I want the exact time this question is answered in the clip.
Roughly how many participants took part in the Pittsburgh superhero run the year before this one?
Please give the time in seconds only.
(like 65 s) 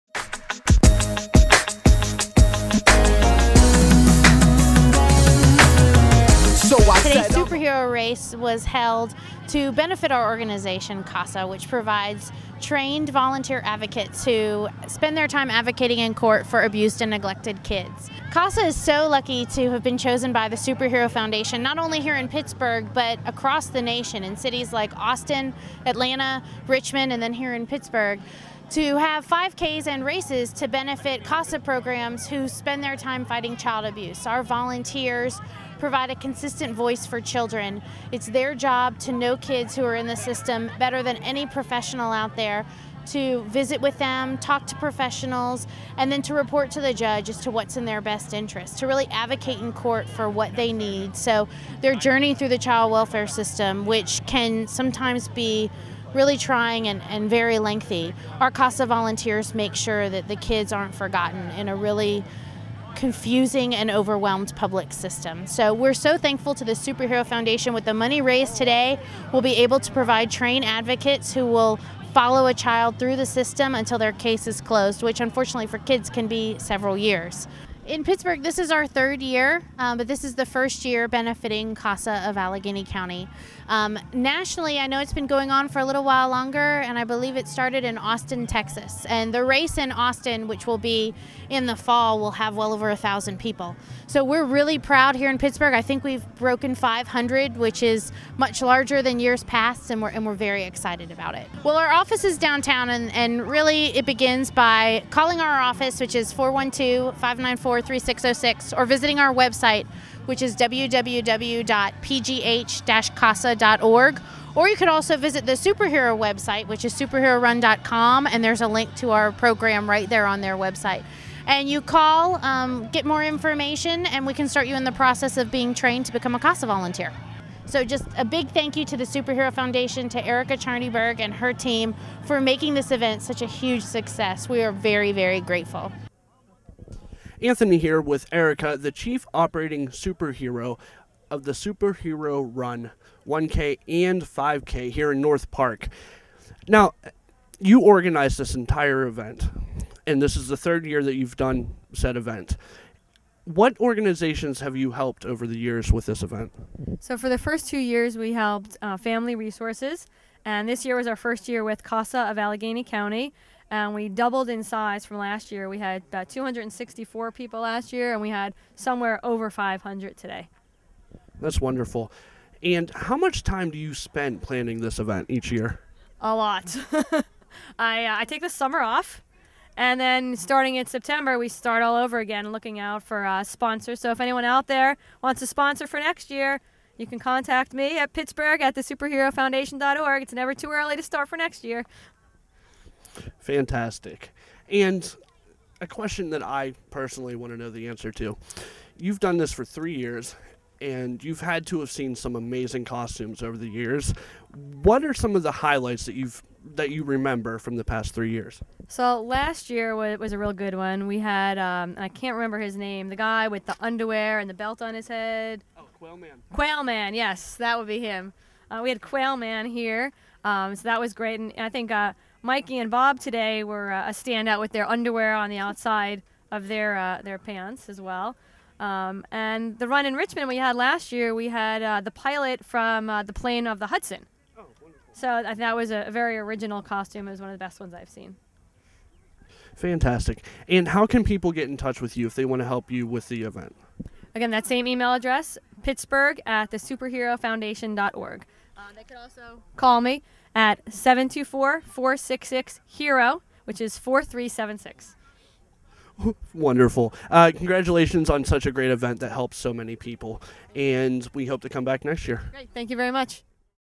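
166 s.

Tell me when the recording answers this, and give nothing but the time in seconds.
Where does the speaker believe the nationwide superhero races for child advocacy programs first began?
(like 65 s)
87 s.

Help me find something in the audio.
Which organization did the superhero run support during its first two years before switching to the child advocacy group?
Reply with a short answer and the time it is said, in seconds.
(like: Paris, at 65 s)
Family Resources, at 158 s.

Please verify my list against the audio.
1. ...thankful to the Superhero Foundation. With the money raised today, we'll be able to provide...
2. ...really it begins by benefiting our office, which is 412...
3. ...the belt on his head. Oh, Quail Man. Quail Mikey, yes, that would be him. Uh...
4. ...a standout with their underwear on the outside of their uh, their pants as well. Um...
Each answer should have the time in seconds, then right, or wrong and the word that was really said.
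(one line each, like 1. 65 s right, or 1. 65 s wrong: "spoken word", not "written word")
1. 66 s right
2. 103 s wrong: "calling", not "benefiting"
3. 214 s wrong: "Man", not "Mikey"
4. 224 s right.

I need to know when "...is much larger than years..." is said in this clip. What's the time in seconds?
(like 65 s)
97 s.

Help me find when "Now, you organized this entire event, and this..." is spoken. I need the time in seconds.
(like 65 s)
146 s.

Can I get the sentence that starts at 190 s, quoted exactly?
It's never too early to start for next year.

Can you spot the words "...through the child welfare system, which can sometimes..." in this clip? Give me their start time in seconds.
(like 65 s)
52 s.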